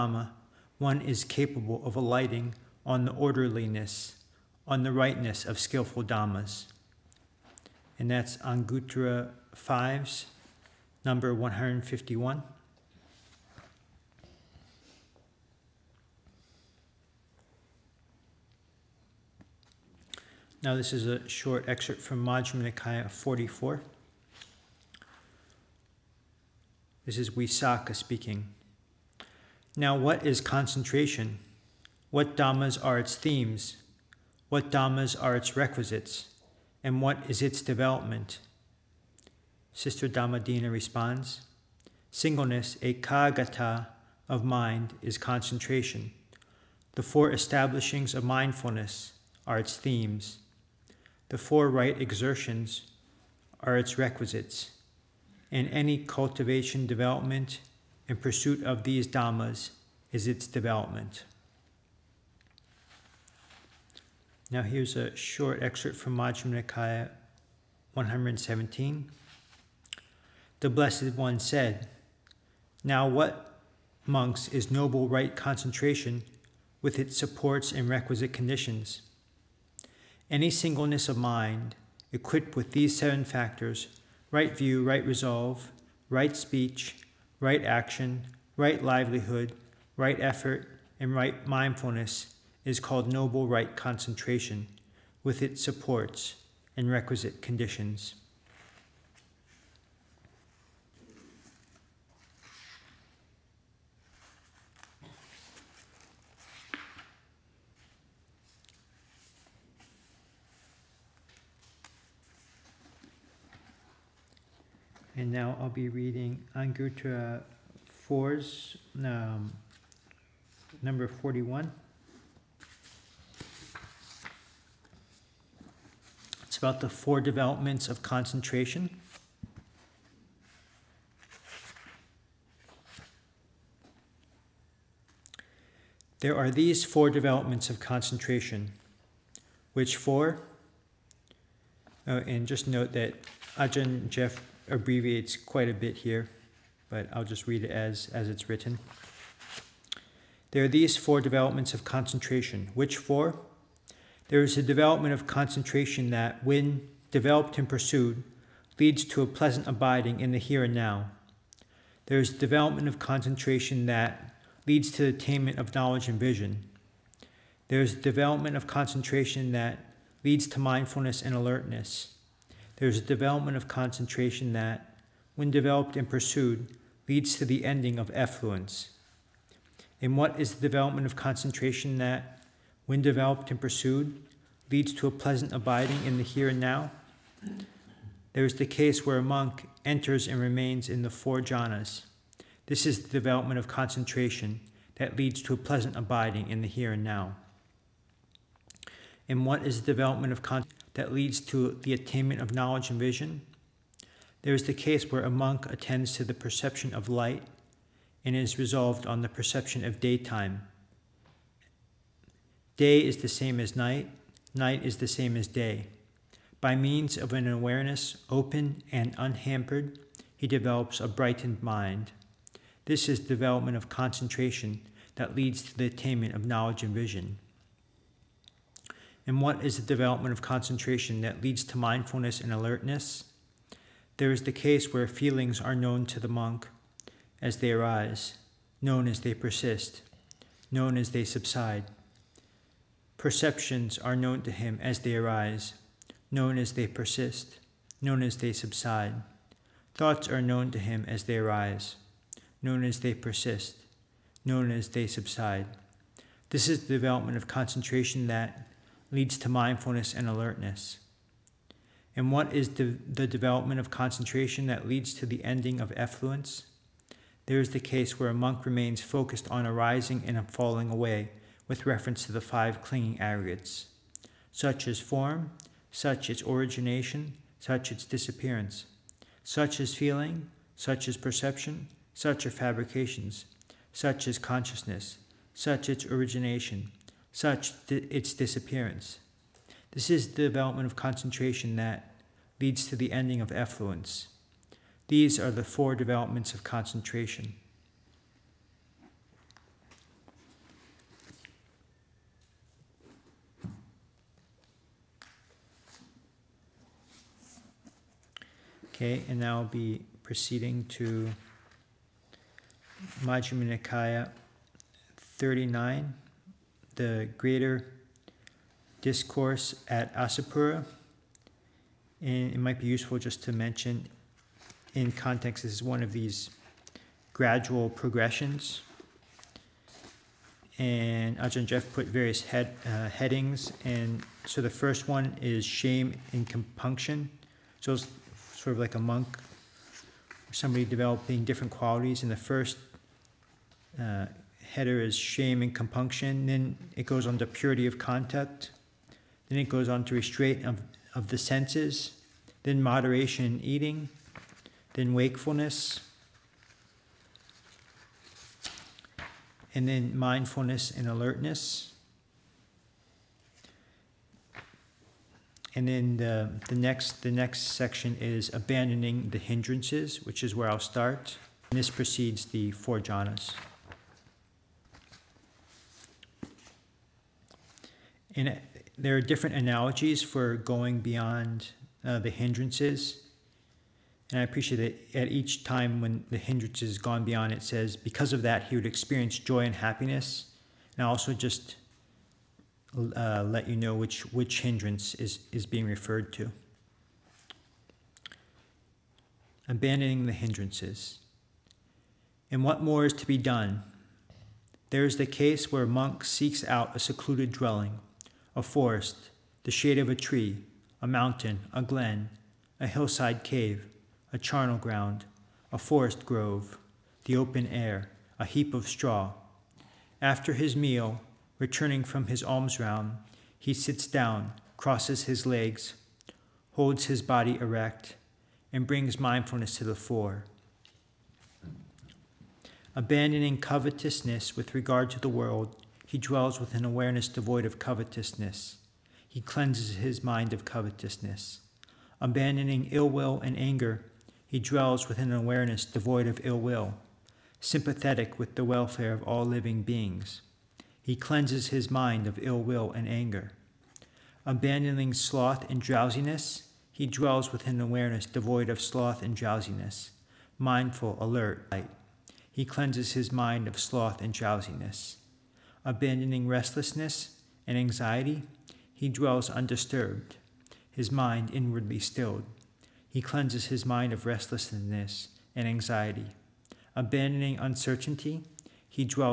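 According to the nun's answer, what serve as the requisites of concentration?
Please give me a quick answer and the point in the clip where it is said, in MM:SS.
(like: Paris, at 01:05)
The four right exertions, at 00:51.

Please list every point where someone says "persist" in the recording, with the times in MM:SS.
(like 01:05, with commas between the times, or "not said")
03:59, 04:06, 04:13.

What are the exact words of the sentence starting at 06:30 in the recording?
And I also just uh, let you know which, which hindrance is, is being referred to.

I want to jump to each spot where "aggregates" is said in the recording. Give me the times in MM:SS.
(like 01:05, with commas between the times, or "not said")
04:33.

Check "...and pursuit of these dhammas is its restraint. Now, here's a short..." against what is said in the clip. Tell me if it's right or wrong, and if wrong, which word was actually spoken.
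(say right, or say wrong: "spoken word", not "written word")
wrong: "development", not "restraint".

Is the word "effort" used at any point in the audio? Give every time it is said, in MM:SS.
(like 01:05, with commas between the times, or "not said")
01:30.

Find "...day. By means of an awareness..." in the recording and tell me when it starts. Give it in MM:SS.
03:35.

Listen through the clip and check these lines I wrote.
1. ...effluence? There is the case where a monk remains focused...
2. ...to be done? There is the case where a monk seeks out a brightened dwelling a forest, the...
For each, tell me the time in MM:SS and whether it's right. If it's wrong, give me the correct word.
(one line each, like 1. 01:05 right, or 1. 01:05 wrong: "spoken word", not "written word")
1. 04:25 right
2. 06:43 wrong: "secluded", not "brightened".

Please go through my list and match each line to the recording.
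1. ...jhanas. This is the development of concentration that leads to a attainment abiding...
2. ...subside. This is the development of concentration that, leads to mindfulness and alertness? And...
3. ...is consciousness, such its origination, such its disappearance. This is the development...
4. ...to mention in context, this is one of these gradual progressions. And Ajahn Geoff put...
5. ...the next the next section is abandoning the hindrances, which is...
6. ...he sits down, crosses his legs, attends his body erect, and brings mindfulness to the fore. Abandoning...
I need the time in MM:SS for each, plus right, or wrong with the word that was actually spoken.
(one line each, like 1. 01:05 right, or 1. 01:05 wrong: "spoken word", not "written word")
1. 03:11 wrong: "pleasant", not "attainment"
2. 04:15 right
3. 04:44 right
4. 05:23 right
5. 06:06 right
6. 07:03 wrong: "holds", not "attends".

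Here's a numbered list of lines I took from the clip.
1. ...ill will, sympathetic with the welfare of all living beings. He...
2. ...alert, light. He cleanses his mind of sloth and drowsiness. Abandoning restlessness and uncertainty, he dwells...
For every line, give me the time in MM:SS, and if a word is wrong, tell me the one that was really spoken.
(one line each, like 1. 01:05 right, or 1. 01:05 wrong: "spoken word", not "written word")
1. 07:26 right
2. 07:41 wrong: "anxiety", not "uncertainty".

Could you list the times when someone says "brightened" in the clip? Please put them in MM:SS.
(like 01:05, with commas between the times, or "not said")
03:41.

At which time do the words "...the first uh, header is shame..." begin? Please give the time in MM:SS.
05:42.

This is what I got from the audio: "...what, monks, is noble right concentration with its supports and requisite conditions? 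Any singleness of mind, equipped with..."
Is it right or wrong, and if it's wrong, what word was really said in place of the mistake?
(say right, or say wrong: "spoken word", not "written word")
right.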